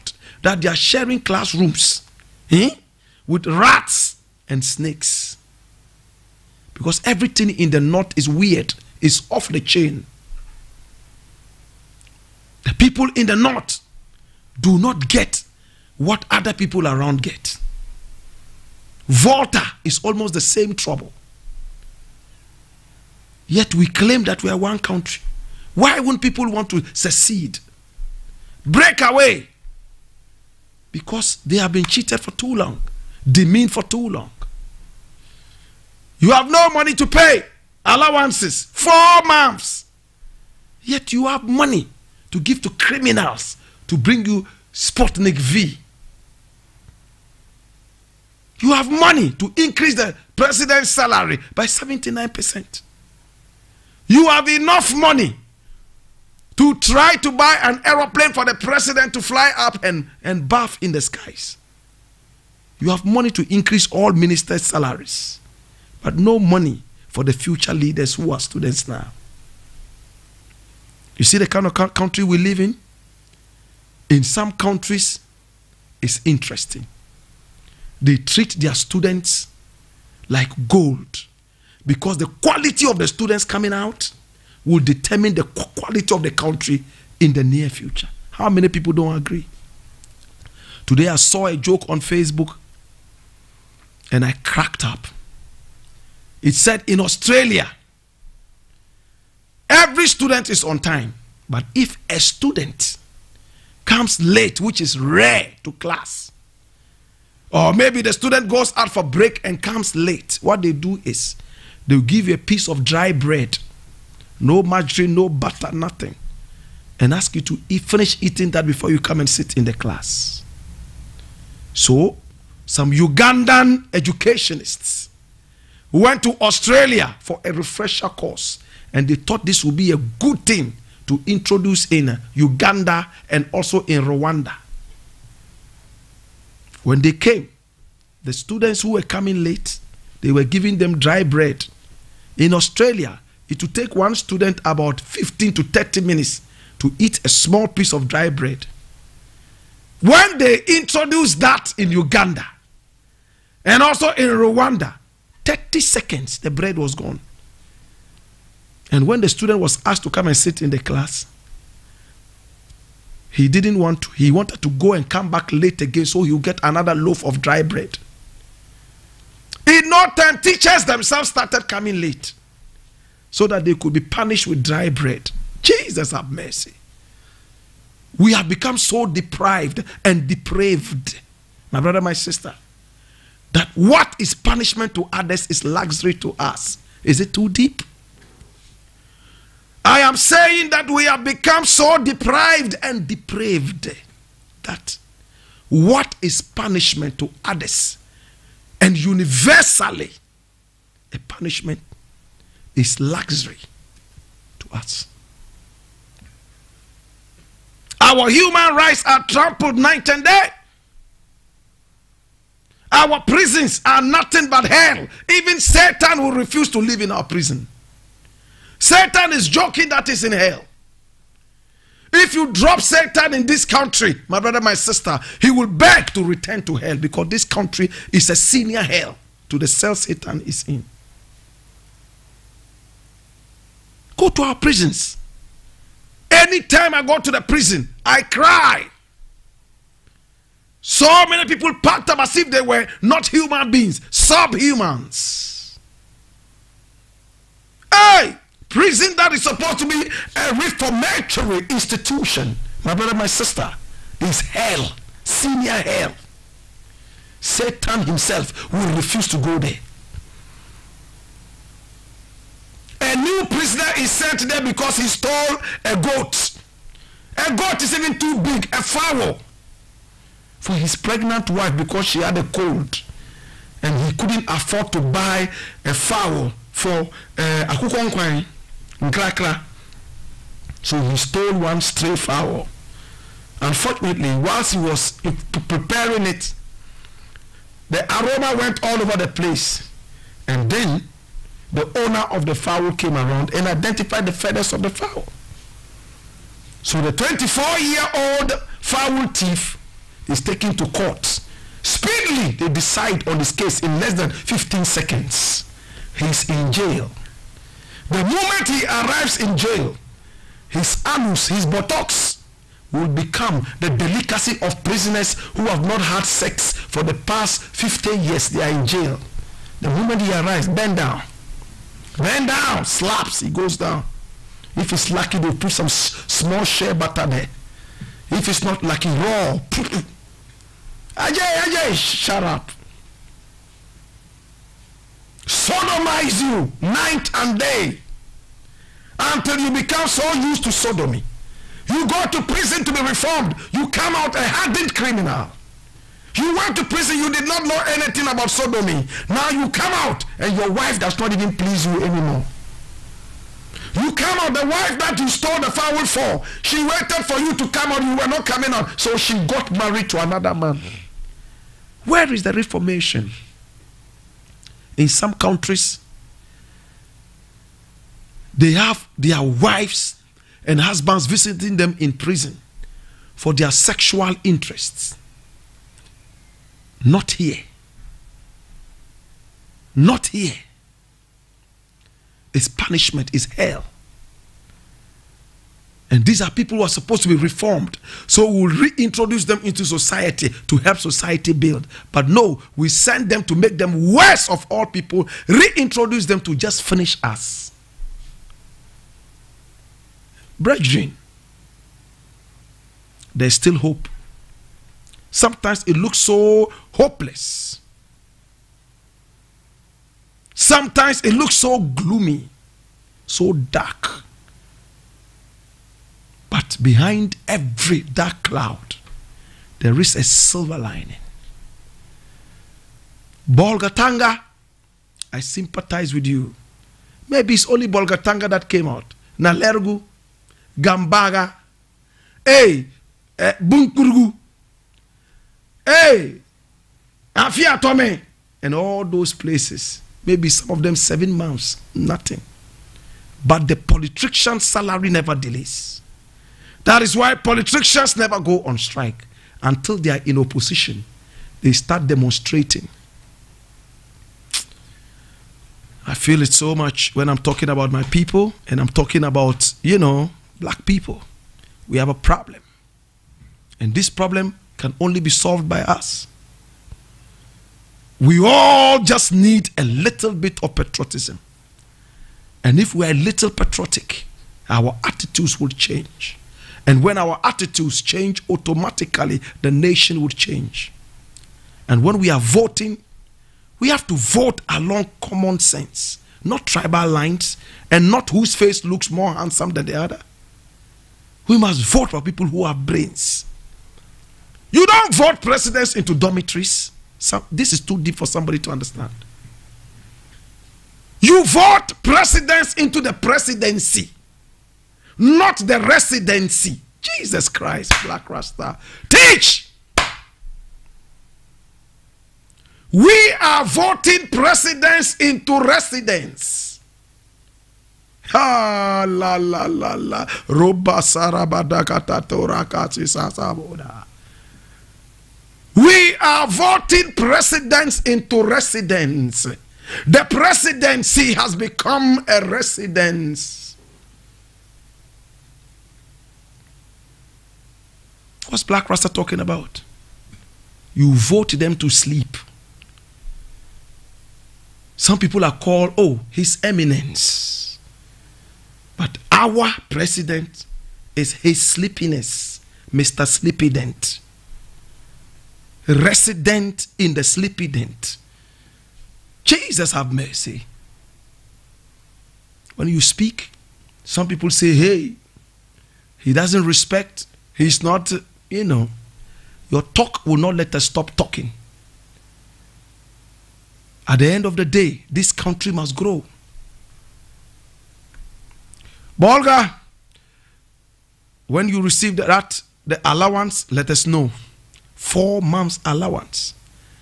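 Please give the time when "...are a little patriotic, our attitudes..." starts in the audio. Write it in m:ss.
7:53.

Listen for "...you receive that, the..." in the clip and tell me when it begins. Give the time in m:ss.
9:41.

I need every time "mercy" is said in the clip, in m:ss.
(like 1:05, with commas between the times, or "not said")
2:56, 9:20.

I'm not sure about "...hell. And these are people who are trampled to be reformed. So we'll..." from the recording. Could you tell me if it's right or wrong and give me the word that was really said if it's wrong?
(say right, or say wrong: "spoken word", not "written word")
wrong: "supposed", not "trampled".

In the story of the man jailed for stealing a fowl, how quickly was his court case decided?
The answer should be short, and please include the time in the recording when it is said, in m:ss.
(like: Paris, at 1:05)
less than 15 seconds, at 5:03.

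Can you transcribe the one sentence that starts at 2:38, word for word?
And when the student was asked to come and sit in the class, he didn't want to.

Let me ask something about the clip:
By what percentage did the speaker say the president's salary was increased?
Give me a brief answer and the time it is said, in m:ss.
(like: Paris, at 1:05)
79%, at 0:51.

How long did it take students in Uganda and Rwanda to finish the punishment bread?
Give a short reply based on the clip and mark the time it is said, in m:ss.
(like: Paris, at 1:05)
30 seconds, at 2:35.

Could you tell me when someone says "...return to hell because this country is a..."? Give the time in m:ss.
3:46.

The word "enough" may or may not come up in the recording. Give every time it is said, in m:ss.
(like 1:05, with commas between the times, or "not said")
0:54.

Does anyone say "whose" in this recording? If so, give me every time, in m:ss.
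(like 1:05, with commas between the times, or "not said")
8:08.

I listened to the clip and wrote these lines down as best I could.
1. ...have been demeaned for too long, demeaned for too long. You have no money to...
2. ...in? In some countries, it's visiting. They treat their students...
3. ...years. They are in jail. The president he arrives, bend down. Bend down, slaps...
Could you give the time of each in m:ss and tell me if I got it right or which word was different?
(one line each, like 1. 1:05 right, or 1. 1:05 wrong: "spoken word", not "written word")
1. 0:31 wrong: "cheated", not "demeaned"
2. 1:12 wrong: "interesting", not "visiting"
3. 5:18 wrong: "moment", not "president".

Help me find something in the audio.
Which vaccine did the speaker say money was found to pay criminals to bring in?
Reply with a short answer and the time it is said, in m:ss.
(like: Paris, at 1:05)
Sputnik V, at 0:44.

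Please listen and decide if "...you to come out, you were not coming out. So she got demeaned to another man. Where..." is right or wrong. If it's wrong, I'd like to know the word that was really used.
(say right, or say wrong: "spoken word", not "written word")
wrong: "married", not "demeaned".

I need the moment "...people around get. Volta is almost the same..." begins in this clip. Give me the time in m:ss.
0:16.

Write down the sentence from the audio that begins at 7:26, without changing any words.
That is why politicians never go on strike until they are in opposition.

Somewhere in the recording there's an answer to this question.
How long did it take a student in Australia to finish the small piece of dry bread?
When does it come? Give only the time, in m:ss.
2:24.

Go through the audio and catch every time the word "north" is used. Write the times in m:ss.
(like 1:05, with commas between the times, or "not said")
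0:07, 0:13.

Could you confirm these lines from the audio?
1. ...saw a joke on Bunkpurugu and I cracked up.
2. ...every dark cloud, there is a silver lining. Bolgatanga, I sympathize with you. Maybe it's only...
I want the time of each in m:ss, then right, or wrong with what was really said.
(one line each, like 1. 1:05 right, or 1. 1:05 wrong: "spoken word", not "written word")
1. 1:31 wrong: "Facebook", not "Bunkpurugu"
2. 6:57 right.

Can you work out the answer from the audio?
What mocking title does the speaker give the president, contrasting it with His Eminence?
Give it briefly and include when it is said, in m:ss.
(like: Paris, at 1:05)
His Sleepiness, at 9:11.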